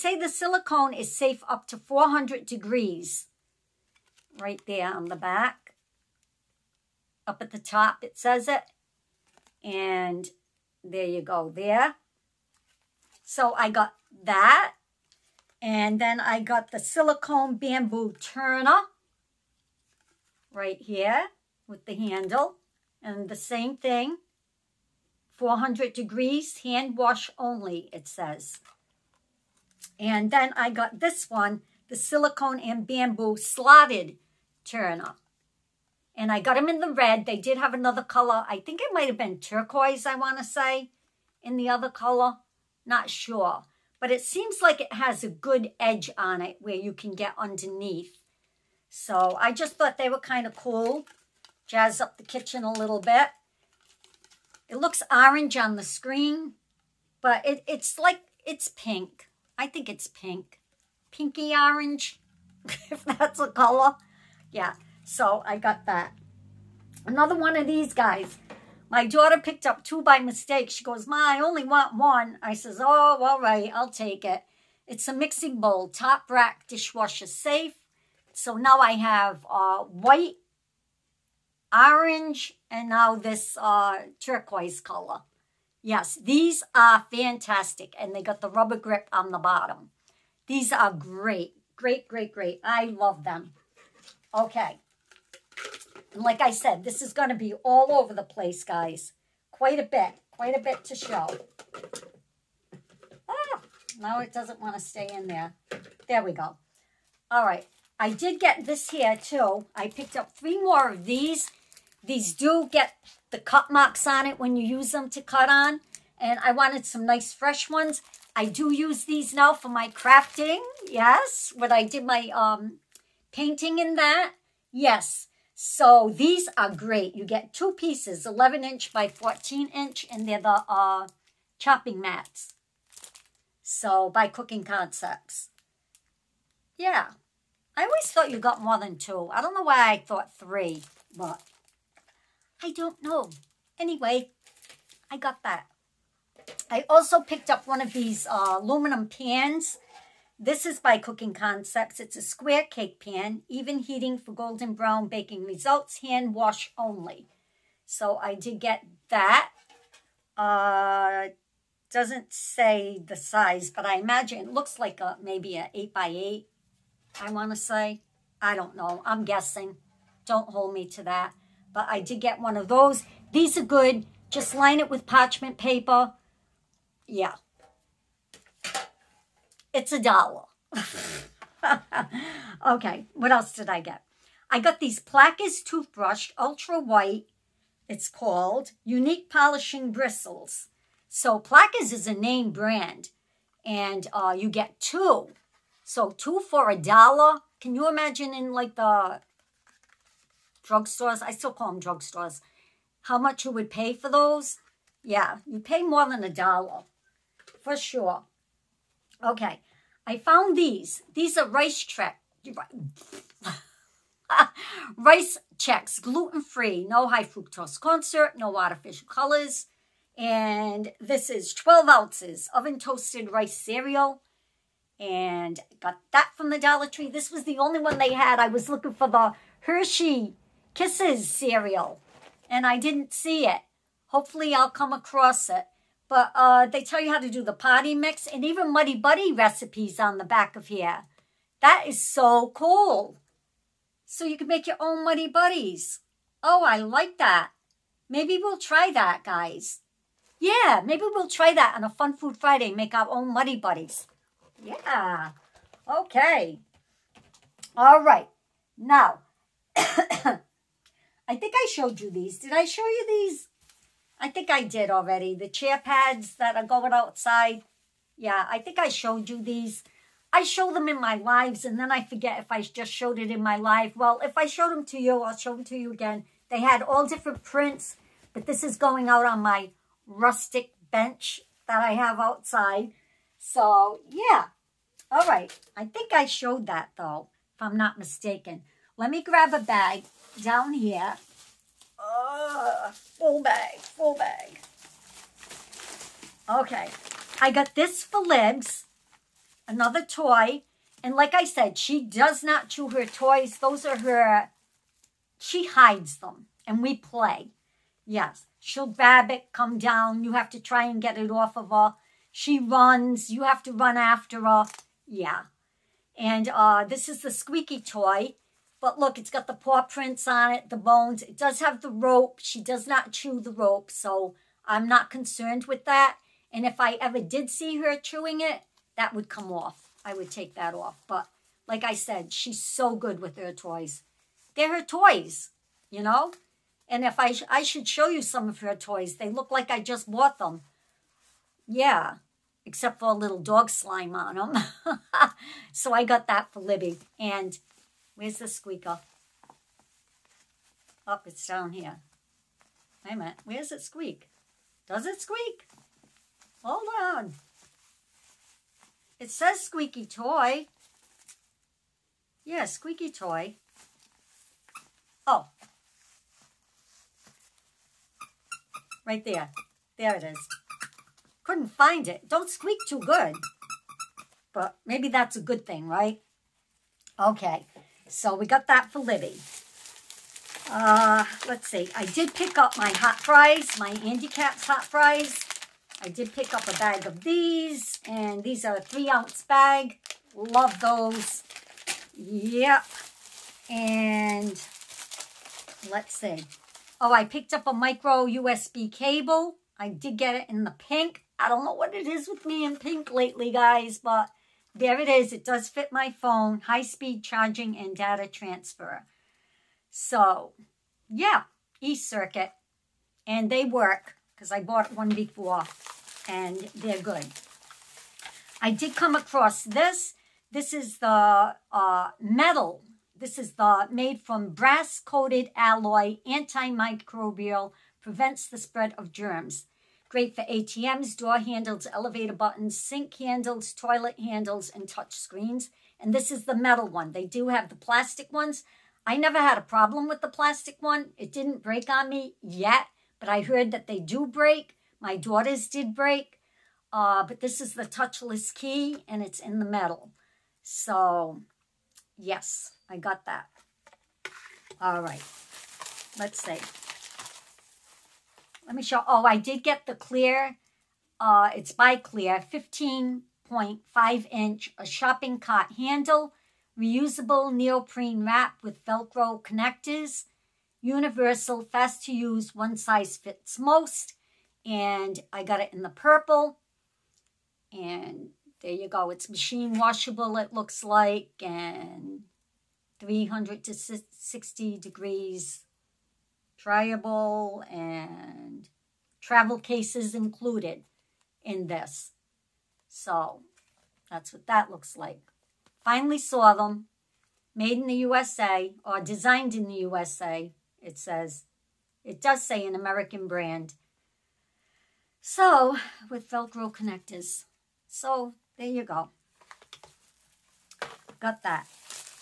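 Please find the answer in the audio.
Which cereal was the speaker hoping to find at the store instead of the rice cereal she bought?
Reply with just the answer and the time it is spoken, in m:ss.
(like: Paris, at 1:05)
Hershey Kisses cereal, at 3:49.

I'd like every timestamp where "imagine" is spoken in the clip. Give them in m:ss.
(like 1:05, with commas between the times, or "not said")
2:43, 3:17.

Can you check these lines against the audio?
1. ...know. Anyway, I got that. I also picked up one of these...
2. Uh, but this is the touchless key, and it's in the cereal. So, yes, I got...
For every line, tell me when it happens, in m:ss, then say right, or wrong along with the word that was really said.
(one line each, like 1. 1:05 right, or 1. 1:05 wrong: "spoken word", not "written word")
1. 2:23 right
2. 7:26 wrong: "metal", not "cereal".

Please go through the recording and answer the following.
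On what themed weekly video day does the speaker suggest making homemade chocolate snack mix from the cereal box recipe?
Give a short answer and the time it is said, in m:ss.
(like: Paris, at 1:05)
Fun Food Friday, at 4:11.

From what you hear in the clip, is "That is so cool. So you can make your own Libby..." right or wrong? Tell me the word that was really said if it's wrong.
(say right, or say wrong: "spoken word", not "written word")
wrong: "Muddy", not "Libby".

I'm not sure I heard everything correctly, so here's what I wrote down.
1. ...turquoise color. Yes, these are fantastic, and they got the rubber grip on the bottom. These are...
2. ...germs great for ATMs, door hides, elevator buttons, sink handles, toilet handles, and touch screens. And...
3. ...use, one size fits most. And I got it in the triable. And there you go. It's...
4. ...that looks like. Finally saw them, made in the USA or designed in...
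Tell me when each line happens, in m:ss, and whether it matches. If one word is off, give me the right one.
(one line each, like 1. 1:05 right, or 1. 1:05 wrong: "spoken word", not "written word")
1. 1:24 right
2. 7:09 wrong: "handles", not "hides"
3. 7:52 wrong: "purple", not "triable"
4. 8:14 right.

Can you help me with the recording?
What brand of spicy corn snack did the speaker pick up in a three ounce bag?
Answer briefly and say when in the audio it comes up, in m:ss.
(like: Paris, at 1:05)
Andy Capp's, at 6:24.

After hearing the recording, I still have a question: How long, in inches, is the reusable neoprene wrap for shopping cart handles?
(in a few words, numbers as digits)
15.5 inch.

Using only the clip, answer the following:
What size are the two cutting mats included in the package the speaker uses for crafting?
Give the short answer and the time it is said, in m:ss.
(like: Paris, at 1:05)
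11 inch by 14 inch, at 2:08.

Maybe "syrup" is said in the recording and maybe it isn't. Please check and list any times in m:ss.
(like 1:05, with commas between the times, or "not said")
3:38.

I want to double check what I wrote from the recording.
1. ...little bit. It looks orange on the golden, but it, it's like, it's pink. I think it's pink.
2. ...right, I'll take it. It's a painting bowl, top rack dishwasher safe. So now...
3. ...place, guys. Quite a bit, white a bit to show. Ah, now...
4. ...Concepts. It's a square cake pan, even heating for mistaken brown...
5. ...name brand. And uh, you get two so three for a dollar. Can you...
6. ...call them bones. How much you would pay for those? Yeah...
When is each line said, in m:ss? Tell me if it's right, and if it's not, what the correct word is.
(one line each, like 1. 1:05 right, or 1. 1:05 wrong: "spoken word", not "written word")
1. 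0:52 wrong: "screen", not "golden"
2. 1:13 wrong: "mixing", not "painting"
3. 1:38 wrong: "quite", not "white"
4. 2:31 wrong: "golden", not "mistaken"
5. 3:12 wrong: "two", not "three"
6. 3:21 wrong: "drugstores", not "bones".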